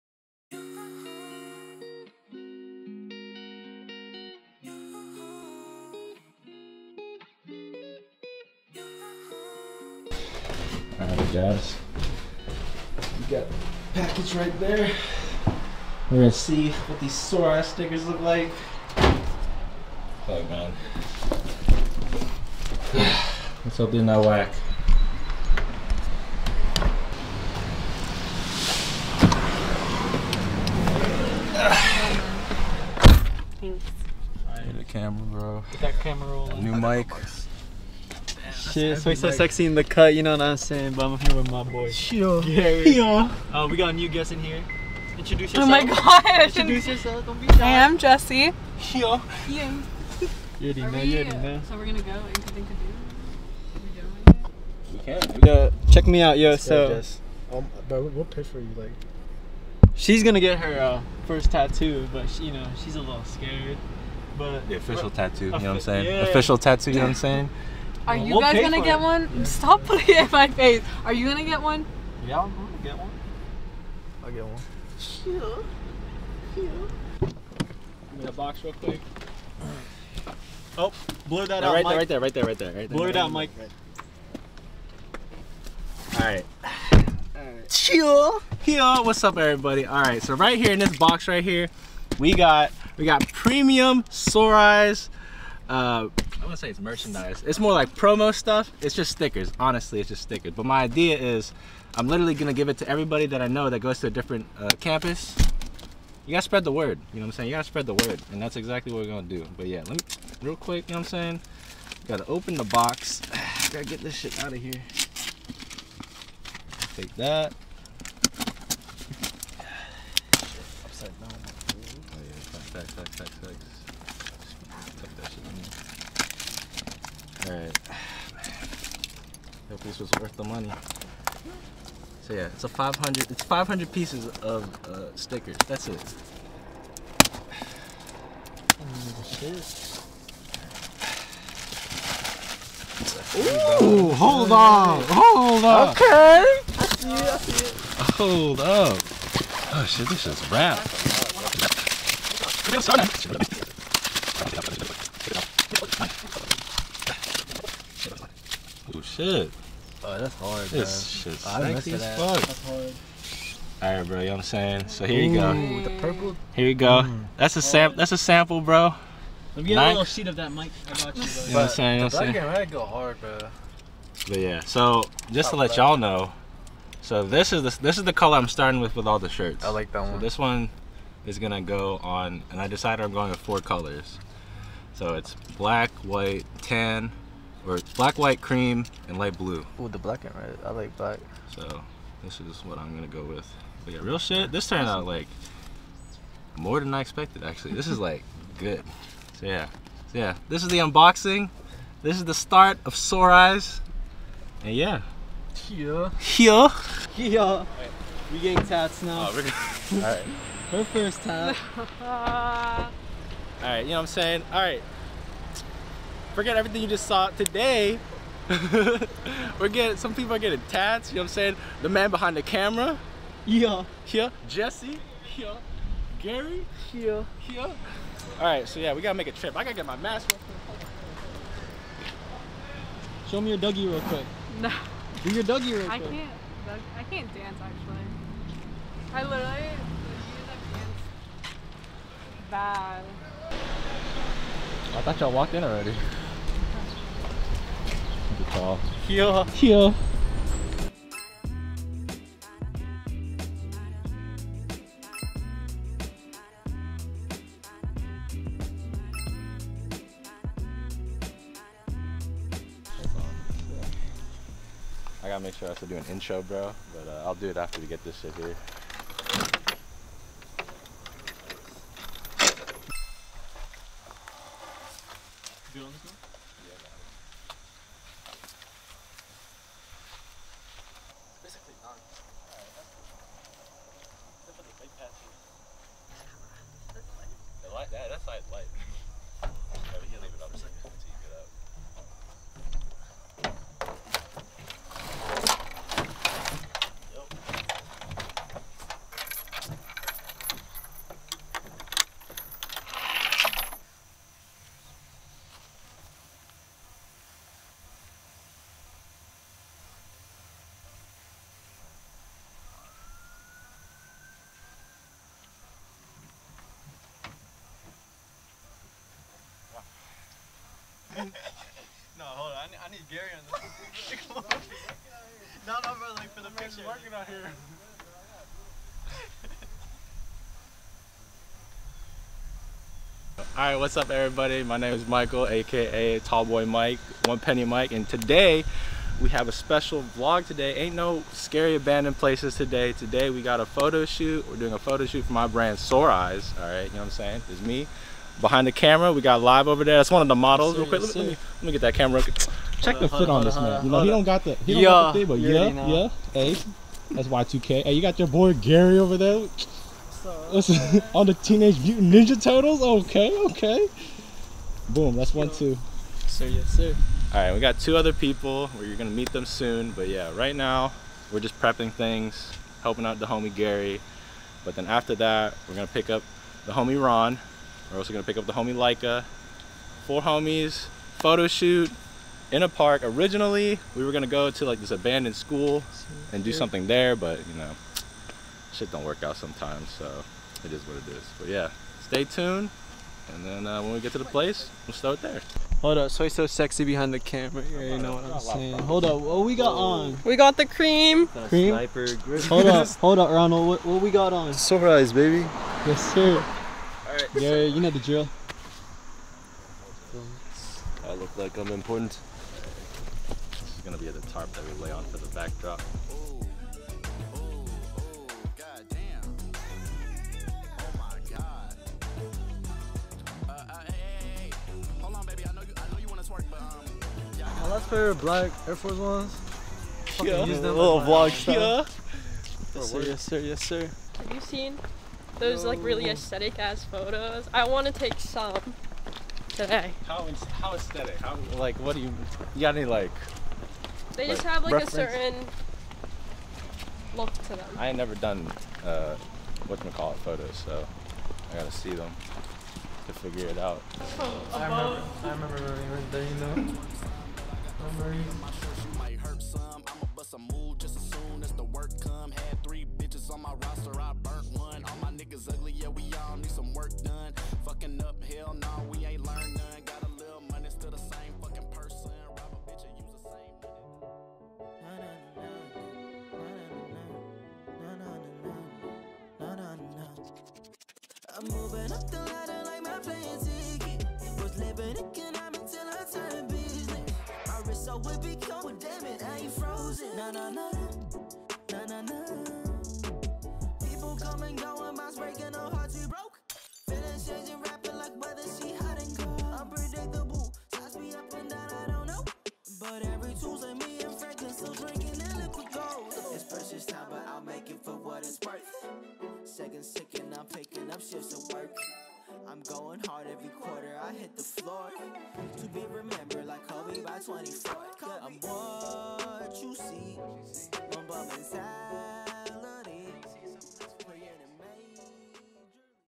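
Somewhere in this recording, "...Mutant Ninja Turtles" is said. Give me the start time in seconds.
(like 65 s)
361 s.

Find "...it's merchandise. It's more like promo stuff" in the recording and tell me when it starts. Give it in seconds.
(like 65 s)
96 s.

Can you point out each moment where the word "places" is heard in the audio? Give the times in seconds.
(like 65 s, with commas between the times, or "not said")
342 s, 394 s.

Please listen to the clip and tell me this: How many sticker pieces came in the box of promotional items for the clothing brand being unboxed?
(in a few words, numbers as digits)
500.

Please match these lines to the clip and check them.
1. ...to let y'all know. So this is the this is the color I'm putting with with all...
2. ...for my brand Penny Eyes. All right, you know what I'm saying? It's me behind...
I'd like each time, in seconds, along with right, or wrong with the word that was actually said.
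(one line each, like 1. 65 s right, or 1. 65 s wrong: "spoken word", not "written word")
1. 175 s wrong: "starting", not "putting"
2. 345 s wrong: "Sore", not "Penny".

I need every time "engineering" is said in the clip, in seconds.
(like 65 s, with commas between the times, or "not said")
not said.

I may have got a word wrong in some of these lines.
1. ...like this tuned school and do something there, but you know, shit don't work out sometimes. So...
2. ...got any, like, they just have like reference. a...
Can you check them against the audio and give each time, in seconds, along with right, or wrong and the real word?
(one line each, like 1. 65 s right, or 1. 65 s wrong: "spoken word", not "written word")
1. 384 s wrong: "abandoned", not "tuned"
2. 442 s right.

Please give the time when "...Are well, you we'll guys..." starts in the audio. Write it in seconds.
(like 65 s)
68 s.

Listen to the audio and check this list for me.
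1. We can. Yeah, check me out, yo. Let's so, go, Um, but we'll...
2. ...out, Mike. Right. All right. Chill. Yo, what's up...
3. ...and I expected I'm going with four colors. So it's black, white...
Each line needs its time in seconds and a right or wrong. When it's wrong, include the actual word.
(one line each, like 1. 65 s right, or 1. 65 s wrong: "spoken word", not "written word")
1. 54 s right
2. 83 s right
3. 182 s wrong: "decided", not "expected".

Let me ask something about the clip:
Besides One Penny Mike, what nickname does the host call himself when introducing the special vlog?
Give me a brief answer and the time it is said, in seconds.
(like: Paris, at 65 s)
Tallboy Mike, at 336 s.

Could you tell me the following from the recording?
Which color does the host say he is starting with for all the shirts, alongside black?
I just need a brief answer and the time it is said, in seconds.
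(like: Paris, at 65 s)
Red, at 189 s.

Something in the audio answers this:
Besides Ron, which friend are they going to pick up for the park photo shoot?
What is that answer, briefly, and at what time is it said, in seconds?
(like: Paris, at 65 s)
Lyka, at 378 s.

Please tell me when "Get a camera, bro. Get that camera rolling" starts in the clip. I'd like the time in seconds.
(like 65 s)
34 s.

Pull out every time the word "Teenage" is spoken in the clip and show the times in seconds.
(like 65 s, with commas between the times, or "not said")
361 s.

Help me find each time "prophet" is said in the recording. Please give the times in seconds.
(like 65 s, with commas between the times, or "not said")
not said.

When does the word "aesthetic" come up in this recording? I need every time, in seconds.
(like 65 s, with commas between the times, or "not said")
436 s, 440 s.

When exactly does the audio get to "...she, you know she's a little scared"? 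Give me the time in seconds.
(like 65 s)
62 s.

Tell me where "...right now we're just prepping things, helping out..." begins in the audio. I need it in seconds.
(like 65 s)
370 s.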